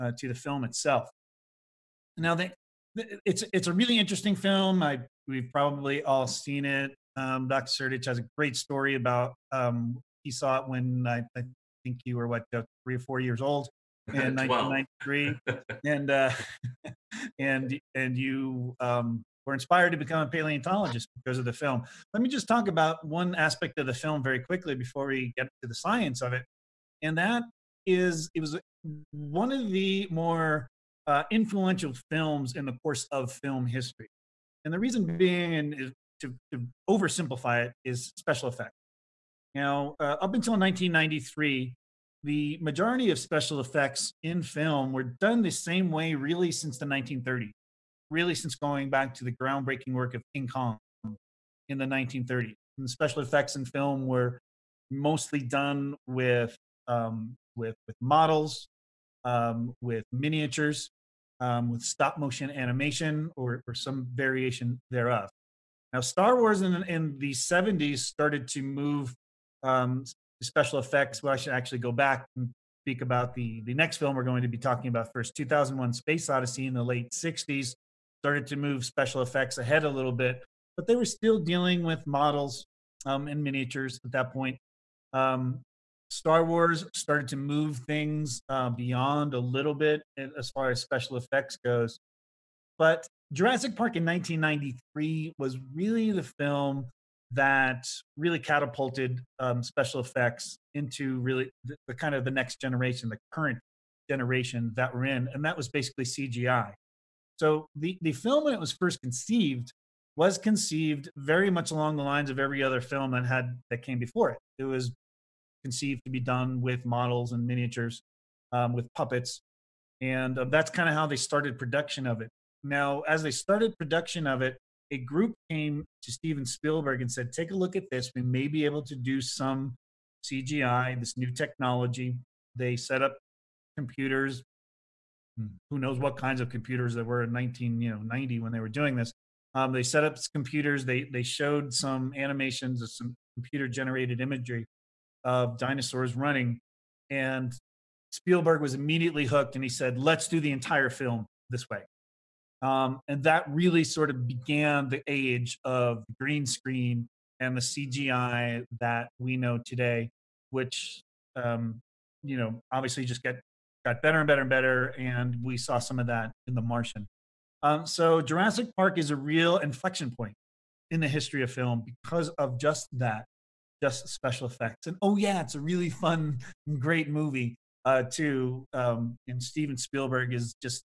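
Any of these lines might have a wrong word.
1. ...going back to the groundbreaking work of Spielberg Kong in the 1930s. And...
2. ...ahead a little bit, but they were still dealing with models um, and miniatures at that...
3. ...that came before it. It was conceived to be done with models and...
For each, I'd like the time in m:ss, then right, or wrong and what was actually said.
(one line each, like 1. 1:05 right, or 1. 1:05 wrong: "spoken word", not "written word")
1. 0:48 wrong: "King", not "Spielberg"
2. 1:19 right
3. 1:53 right.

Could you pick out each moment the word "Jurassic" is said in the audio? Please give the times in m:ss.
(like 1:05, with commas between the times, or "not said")
1:33, 2:48.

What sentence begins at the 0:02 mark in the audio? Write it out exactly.
Now, it's it's a really interesting film.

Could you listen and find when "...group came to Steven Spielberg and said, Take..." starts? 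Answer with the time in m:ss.
2:04.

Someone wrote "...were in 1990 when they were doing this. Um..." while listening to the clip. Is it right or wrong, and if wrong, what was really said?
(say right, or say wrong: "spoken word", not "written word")
right.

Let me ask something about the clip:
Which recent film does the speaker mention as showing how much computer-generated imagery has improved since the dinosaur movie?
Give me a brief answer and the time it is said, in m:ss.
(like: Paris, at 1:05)
The Martian, at 2:46.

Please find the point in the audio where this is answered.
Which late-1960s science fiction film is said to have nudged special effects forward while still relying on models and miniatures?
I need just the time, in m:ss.
1:15.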